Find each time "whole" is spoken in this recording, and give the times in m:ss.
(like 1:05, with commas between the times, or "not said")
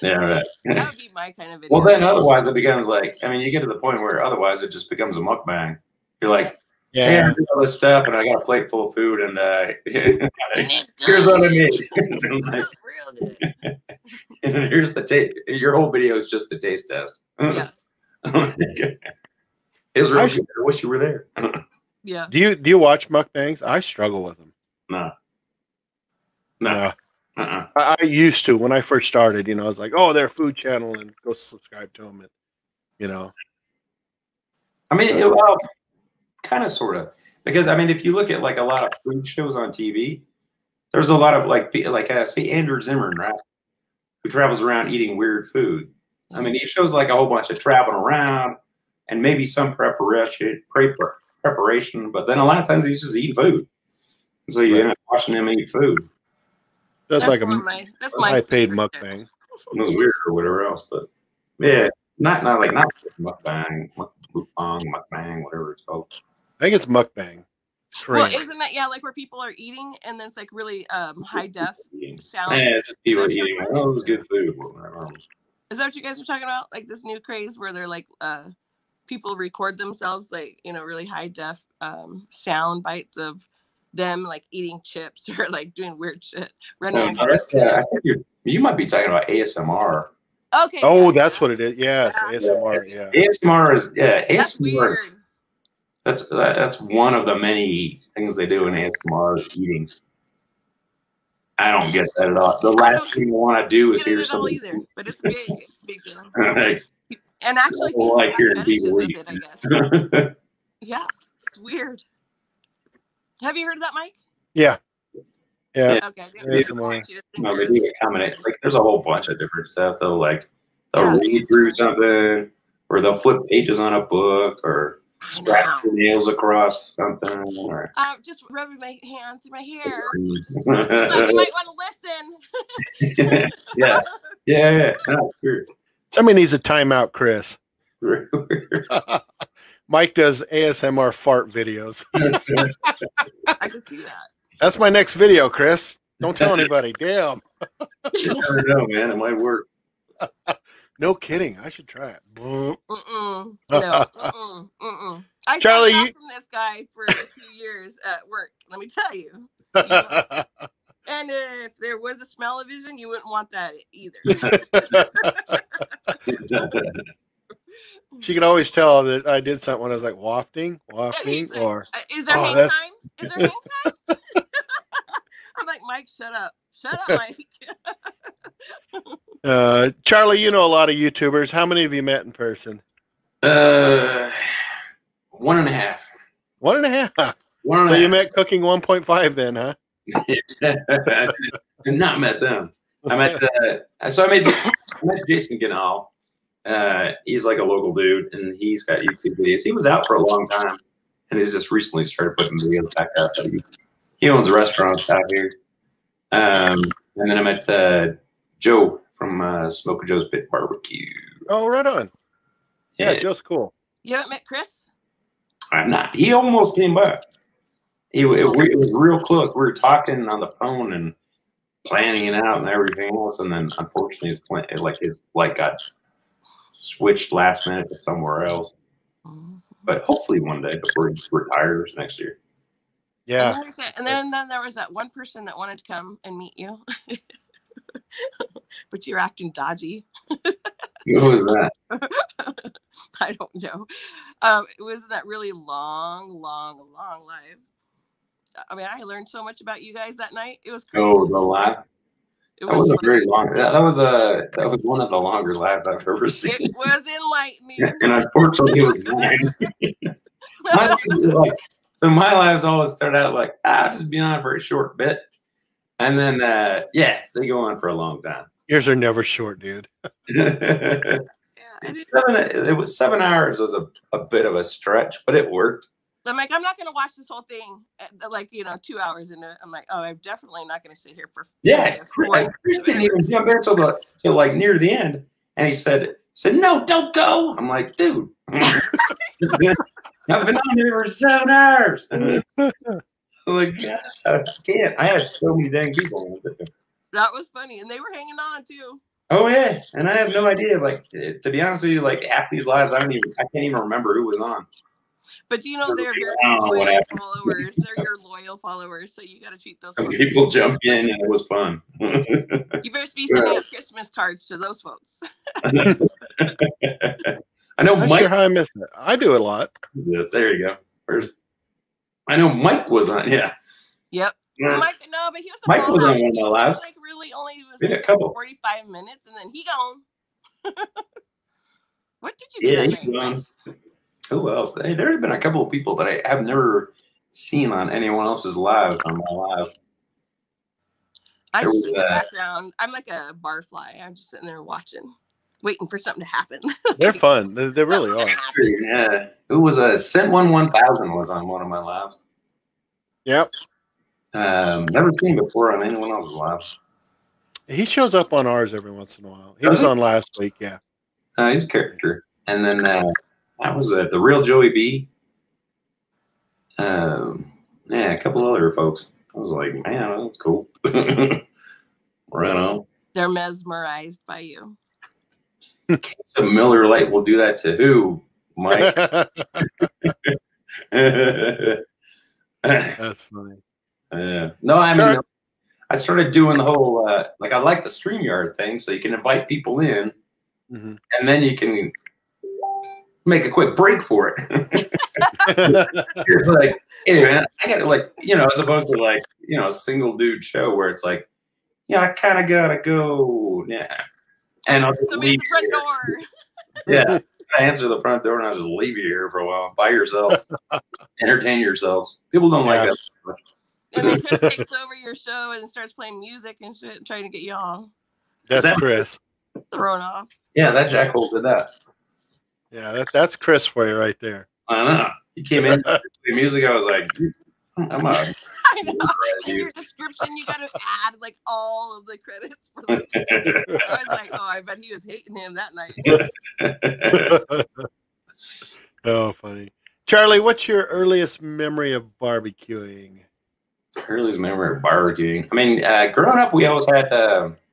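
0:15, 0:47, 1:58, 4:37, 6:26.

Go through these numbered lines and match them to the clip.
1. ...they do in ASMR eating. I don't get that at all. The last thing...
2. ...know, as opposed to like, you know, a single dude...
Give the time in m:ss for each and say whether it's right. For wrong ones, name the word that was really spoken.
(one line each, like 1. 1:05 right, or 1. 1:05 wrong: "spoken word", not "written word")
1. 1:38 right
2. 6:38 right.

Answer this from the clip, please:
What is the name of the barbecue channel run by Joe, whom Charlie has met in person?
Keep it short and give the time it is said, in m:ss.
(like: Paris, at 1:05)
Smokin' Joe's Pit Barbecue, at 3:29.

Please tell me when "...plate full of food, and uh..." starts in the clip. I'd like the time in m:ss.
0:08.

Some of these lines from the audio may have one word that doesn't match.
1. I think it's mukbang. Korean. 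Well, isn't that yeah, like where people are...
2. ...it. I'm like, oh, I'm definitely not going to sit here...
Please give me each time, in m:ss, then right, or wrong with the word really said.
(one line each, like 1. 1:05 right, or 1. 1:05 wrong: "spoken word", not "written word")
1. 1:06 right
2. 4:39 right.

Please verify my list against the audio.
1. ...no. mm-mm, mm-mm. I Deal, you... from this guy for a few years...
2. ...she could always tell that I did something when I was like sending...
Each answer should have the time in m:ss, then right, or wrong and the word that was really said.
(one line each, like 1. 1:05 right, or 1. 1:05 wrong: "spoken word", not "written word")
1. 2:33 wrong: "Charlie", not "Deal"
2. 2:48 wrong: "wafting", not "sending".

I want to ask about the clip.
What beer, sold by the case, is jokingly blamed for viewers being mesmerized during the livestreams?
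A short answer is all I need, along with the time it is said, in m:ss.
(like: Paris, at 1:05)
Miller Lite, at 6:16.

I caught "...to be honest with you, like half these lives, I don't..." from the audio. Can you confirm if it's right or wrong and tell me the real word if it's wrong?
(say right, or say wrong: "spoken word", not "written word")
right.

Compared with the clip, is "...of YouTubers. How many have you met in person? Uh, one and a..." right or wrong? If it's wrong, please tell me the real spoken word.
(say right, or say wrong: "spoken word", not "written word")
right.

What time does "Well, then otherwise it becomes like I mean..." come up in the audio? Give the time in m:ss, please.
0:01.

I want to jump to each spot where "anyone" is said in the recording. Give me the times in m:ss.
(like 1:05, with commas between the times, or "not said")
5:37, 5:55.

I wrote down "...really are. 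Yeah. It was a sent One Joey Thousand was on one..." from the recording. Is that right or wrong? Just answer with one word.
wrong.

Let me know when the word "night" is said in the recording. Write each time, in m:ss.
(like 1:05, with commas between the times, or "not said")
4:10, 7:17.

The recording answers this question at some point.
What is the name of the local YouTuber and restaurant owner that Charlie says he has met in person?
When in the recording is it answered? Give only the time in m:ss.
3:15.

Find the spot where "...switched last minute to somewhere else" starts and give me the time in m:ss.
3:46.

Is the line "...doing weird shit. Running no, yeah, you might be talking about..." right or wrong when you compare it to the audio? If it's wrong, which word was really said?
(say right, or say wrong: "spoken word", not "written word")
right.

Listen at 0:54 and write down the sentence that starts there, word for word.
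end up watching him eat food.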